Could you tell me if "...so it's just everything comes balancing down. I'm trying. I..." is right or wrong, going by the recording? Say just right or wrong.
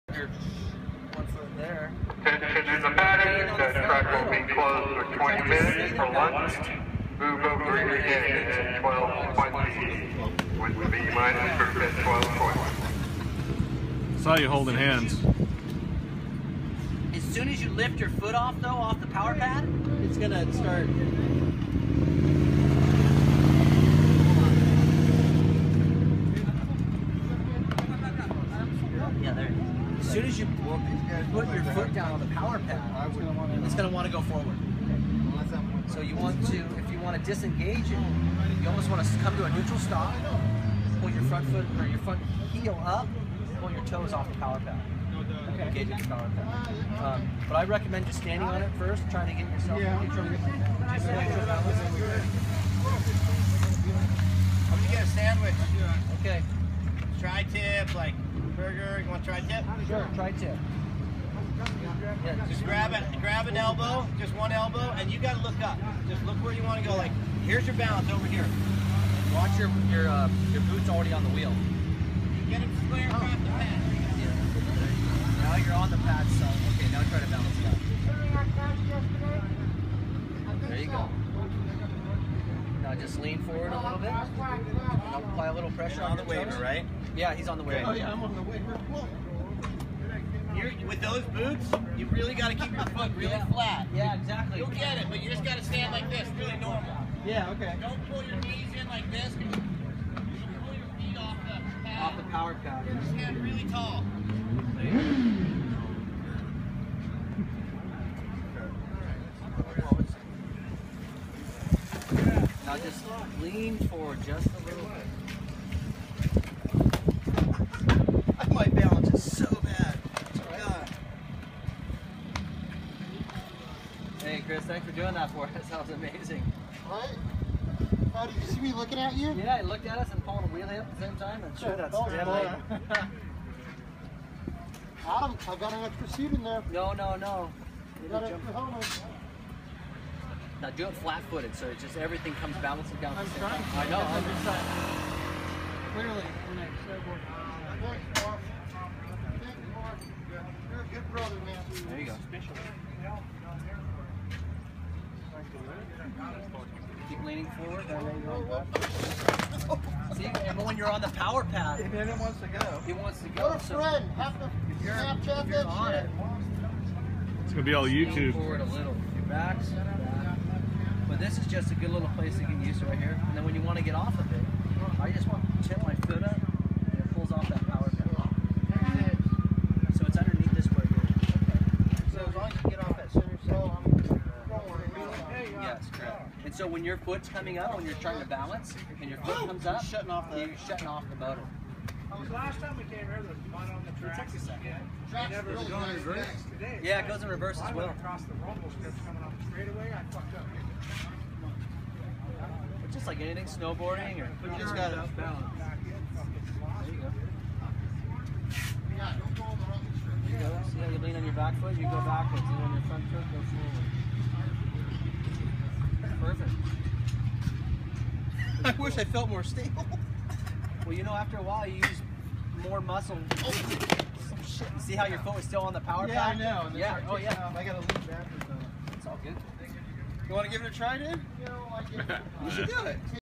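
right.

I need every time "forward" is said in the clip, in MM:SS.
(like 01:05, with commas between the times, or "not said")
00:34, 01:23, 01:53, 02:37, 02:48, 03:36.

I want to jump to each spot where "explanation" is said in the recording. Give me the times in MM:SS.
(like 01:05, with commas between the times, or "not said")
not said.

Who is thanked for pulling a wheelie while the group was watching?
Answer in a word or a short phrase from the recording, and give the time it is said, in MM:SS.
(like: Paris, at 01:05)
Chris, at 02:04.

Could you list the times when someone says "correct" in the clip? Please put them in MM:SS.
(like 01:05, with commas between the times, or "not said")
03:05.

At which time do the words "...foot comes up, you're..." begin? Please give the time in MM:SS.
03:09.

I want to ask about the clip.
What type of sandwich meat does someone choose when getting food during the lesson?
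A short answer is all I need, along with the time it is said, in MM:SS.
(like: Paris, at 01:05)
Tri-tip, at 00:57.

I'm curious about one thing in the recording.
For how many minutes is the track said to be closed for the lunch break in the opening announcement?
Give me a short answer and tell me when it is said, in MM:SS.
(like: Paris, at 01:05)
20, at 00:05.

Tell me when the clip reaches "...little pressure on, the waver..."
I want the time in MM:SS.
01:25.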